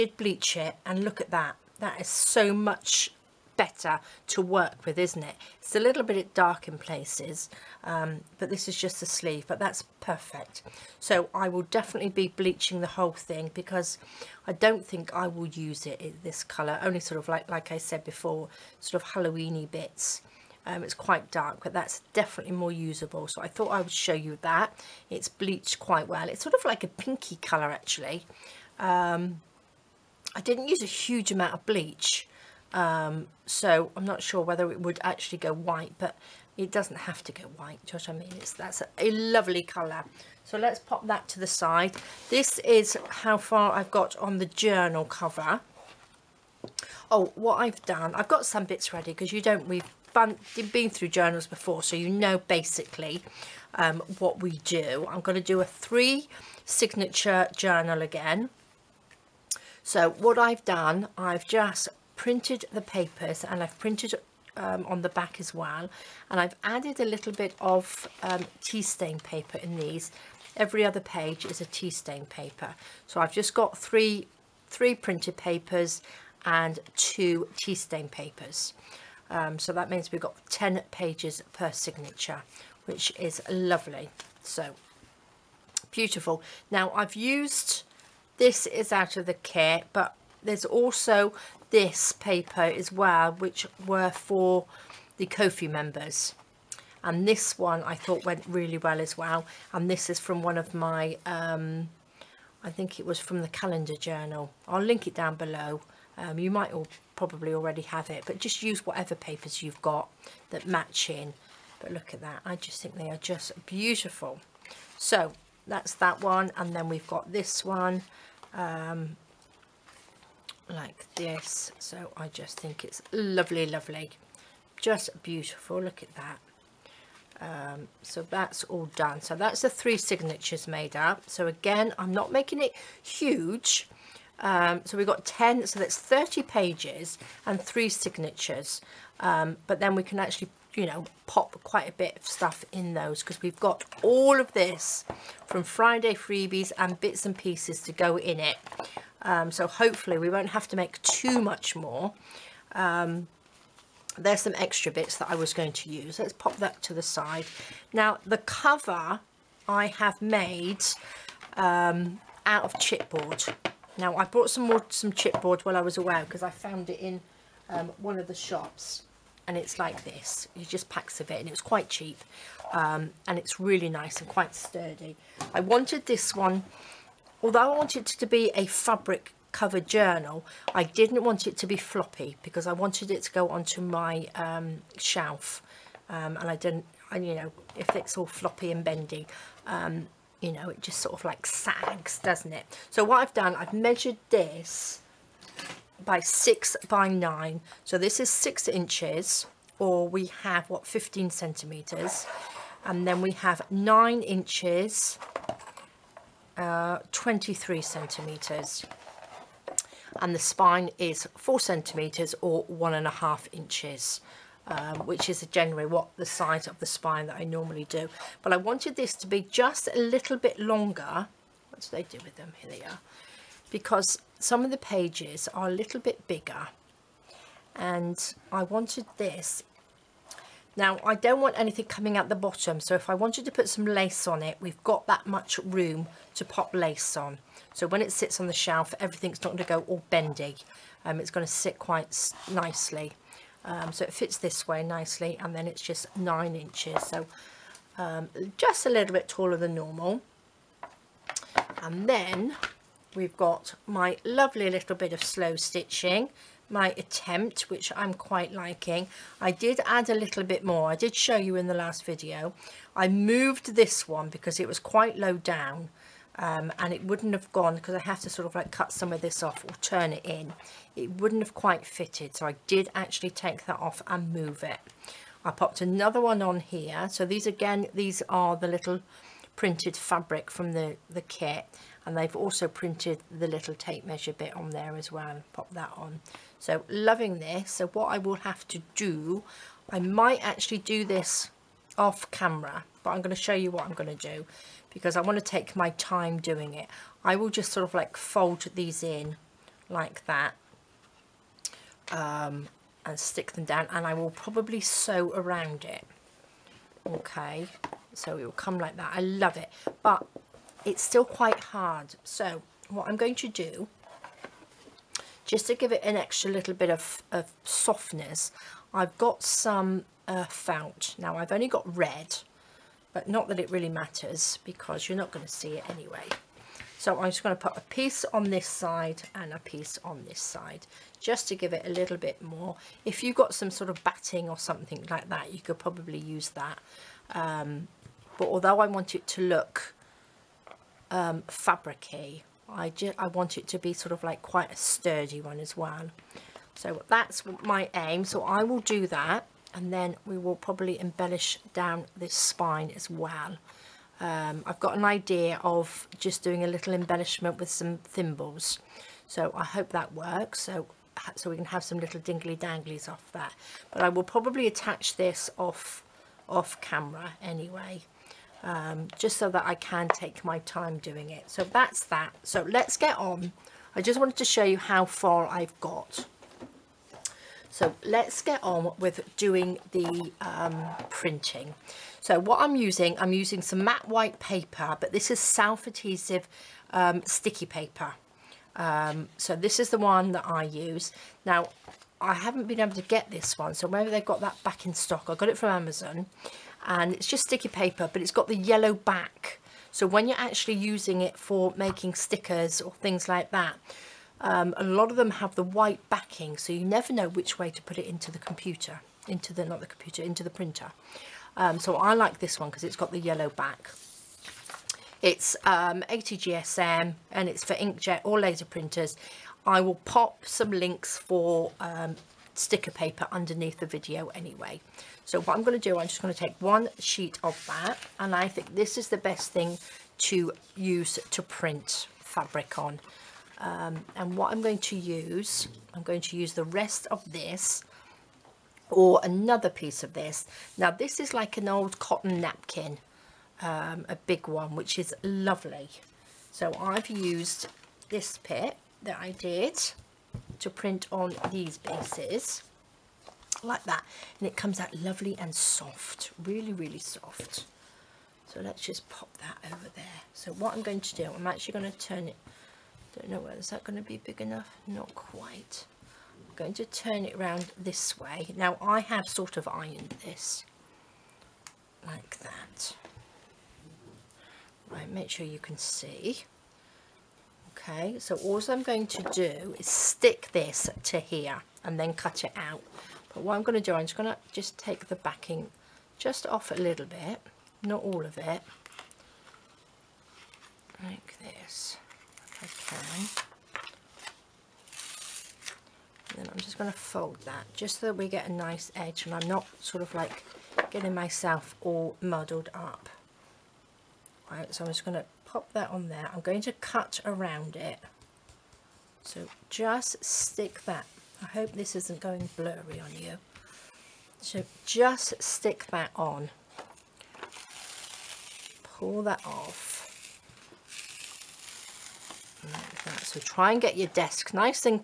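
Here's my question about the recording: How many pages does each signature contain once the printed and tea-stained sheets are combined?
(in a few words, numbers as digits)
10.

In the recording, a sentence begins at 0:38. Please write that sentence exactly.
It's, that's a, a lovely colour.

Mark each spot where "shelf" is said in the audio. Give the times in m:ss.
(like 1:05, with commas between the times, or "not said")
3:04, 3:58.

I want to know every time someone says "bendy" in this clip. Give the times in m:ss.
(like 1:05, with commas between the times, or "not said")
3:08, 4:00.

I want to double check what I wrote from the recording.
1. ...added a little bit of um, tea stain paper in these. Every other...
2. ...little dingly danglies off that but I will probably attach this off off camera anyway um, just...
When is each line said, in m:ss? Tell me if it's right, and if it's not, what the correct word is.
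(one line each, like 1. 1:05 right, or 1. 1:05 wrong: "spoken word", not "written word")
1. 1:06 right
2. 6:01 right.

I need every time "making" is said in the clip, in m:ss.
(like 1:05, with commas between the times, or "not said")
2:12, 6:41.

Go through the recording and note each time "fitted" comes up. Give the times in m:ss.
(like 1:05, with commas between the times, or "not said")
4:31.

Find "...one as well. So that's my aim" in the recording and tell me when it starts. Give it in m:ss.
5:45.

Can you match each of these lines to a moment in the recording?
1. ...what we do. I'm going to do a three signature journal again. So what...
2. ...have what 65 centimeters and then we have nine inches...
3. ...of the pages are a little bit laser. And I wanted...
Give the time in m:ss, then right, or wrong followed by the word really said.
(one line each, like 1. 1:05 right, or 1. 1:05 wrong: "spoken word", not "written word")
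1. 0:54 right
2. 3:20 wrong: "15", not "65"
3. 3:44 wrong: "bigger", not "laser".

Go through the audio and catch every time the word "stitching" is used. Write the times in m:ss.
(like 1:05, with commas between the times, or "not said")
4:15.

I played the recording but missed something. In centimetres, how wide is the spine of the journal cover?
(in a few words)
4.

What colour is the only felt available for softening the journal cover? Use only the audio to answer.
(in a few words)
red.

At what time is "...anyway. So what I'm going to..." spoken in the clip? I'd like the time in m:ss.
7:04.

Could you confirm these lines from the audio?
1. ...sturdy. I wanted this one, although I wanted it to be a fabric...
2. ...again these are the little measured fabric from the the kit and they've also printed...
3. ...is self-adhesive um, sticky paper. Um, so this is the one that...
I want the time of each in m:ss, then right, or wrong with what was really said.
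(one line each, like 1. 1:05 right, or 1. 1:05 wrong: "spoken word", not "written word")
1. 2:54 right
2. 4:37 wrong: "printed", not "measured"
3. 6:25 right.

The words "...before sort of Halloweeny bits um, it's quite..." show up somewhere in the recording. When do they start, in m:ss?
0:18.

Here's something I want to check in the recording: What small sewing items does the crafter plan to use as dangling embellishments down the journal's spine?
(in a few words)
thimbles.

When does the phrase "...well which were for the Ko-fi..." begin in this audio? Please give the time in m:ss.
1:32.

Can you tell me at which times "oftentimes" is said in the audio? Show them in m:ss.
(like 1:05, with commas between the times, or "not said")
not said.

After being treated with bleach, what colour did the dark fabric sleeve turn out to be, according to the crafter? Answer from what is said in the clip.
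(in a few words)
pinky.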